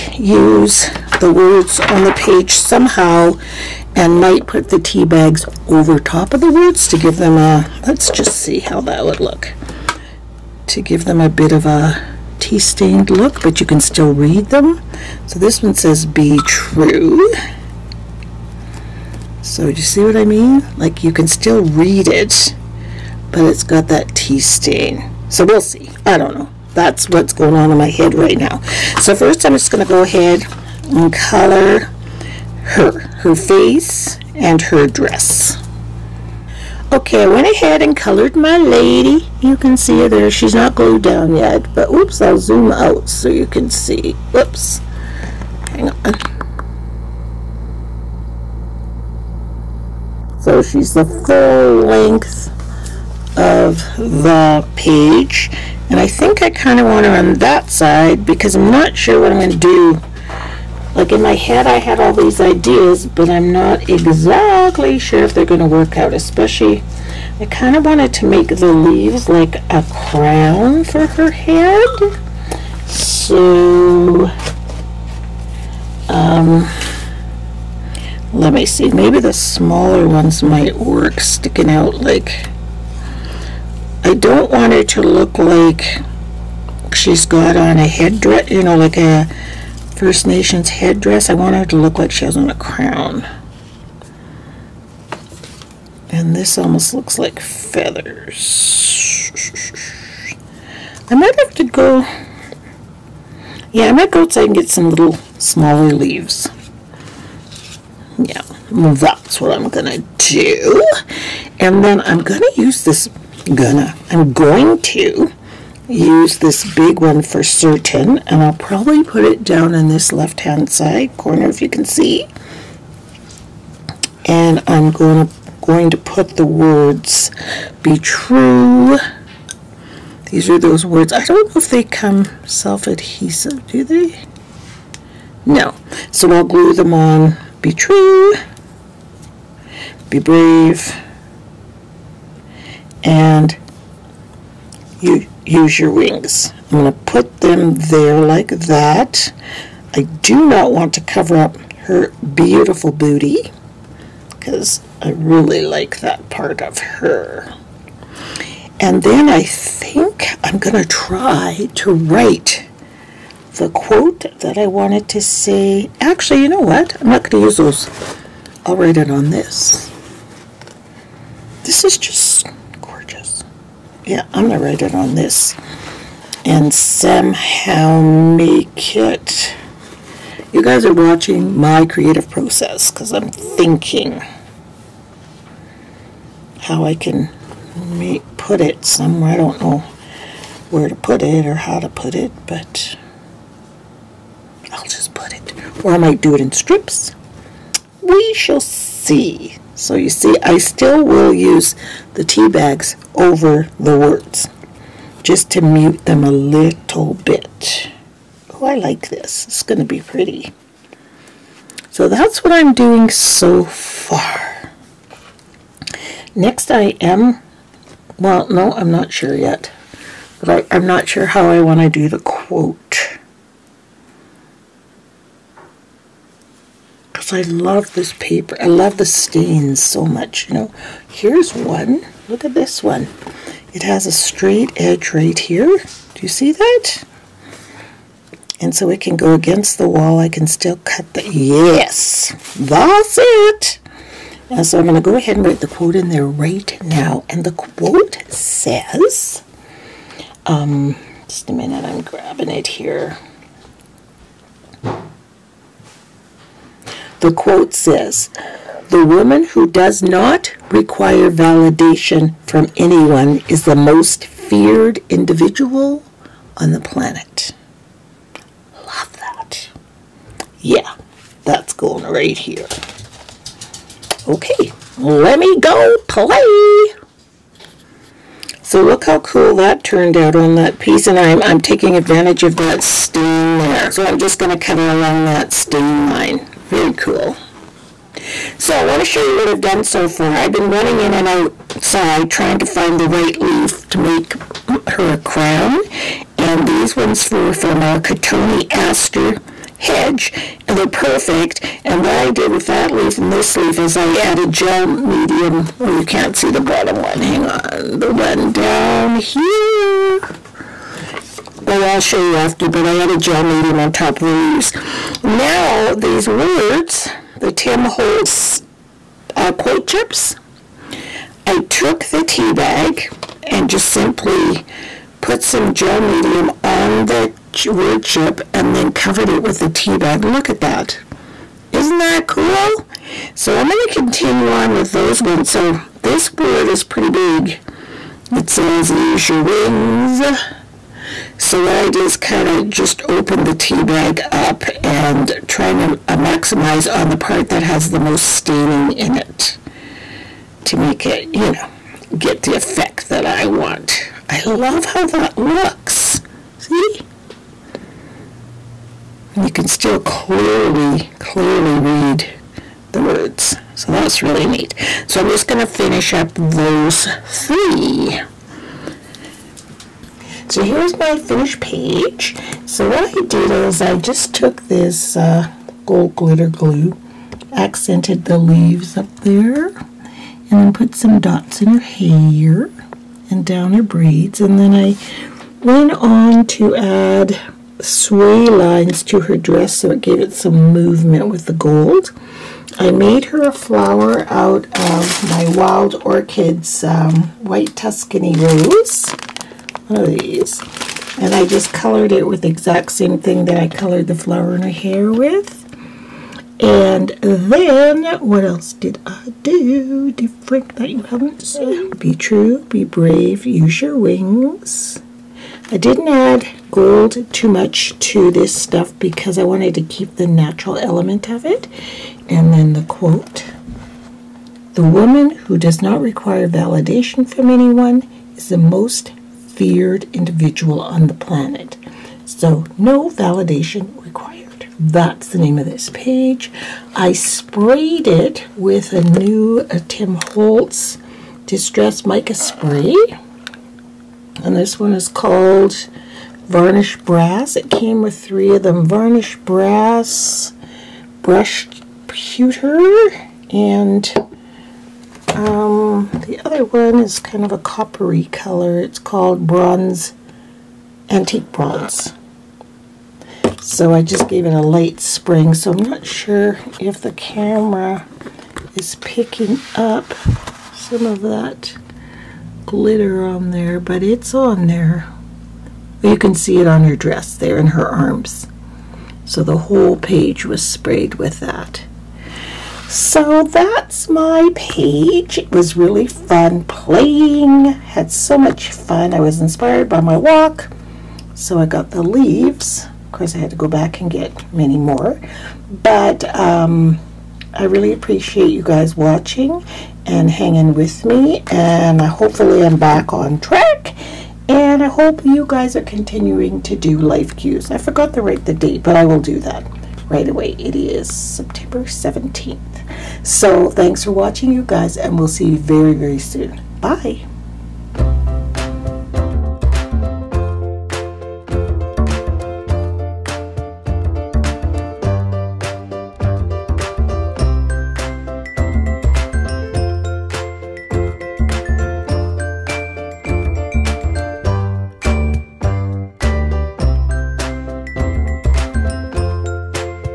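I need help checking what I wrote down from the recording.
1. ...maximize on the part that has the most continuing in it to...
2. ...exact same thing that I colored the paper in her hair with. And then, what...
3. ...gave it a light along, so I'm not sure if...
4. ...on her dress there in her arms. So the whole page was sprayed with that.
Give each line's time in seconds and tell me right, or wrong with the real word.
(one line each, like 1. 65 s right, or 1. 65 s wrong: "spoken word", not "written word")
1. 346 s wrong: "staining", not "continuing"
2. 402 s wrong: "flower", not "paper"
3. 464 s wrong: "spring", not "along"
4. 476 s right.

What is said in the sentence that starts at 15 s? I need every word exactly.
So this one says, be true.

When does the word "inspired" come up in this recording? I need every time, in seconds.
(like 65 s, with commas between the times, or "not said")
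489 s.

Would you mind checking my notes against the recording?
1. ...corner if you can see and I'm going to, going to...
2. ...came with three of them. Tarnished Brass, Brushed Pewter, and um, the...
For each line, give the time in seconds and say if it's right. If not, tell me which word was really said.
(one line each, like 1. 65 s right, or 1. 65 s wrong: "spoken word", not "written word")
1. 121 s right
2. 447 s right.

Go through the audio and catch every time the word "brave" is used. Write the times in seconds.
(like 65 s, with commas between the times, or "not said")
140 s, 412 s.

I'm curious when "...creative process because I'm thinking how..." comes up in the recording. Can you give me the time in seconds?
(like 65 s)
181 s.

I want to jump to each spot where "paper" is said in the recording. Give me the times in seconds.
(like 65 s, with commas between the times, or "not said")
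228 s.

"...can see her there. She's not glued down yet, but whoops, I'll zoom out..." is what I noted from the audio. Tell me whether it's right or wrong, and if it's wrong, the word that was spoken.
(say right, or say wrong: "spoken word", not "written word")
right.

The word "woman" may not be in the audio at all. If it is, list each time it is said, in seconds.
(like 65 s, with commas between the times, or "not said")
259 s, 424 s.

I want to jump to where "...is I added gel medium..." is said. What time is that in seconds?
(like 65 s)
303 s.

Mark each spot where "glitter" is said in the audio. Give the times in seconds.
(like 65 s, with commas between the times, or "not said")
376 s, 472 s.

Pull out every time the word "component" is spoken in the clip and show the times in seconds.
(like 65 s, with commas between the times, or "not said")
not said.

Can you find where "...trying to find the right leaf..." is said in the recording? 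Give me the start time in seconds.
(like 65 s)
292 s.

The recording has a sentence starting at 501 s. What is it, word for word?
And hopefully I'm back on track.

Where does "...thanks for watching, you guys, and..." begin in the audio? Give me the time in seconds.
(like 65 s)
513 s.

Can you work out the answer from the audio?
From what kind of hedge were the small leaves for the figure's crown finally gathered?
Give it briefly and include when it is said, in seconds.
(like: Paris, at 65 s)
Cotoneaster, at 297 s.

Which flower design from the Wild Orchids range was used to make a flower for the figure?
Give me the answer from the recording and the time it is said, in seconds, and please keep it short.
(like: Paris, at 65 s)
White Tuscany Rose, at 397 s.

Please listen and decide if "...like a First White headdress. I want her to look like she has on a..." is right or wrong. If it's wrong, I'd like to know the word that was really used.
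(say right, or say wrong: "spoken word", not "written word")
wrong: "Nations", not "White".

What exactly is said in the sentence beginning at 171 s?
This is just yeah, I'm gonna write it on this.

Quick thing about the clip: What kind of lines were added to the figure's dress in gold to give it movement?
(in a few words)
sway lines.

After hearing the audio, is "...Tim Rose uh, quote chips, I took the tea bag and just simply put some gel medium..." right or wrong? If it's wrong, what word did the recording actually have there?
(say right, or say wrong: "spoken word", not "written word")
wrong: "Holtz", not "Rose".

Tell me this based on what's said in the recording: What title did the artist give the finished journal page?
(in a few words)
No validation required.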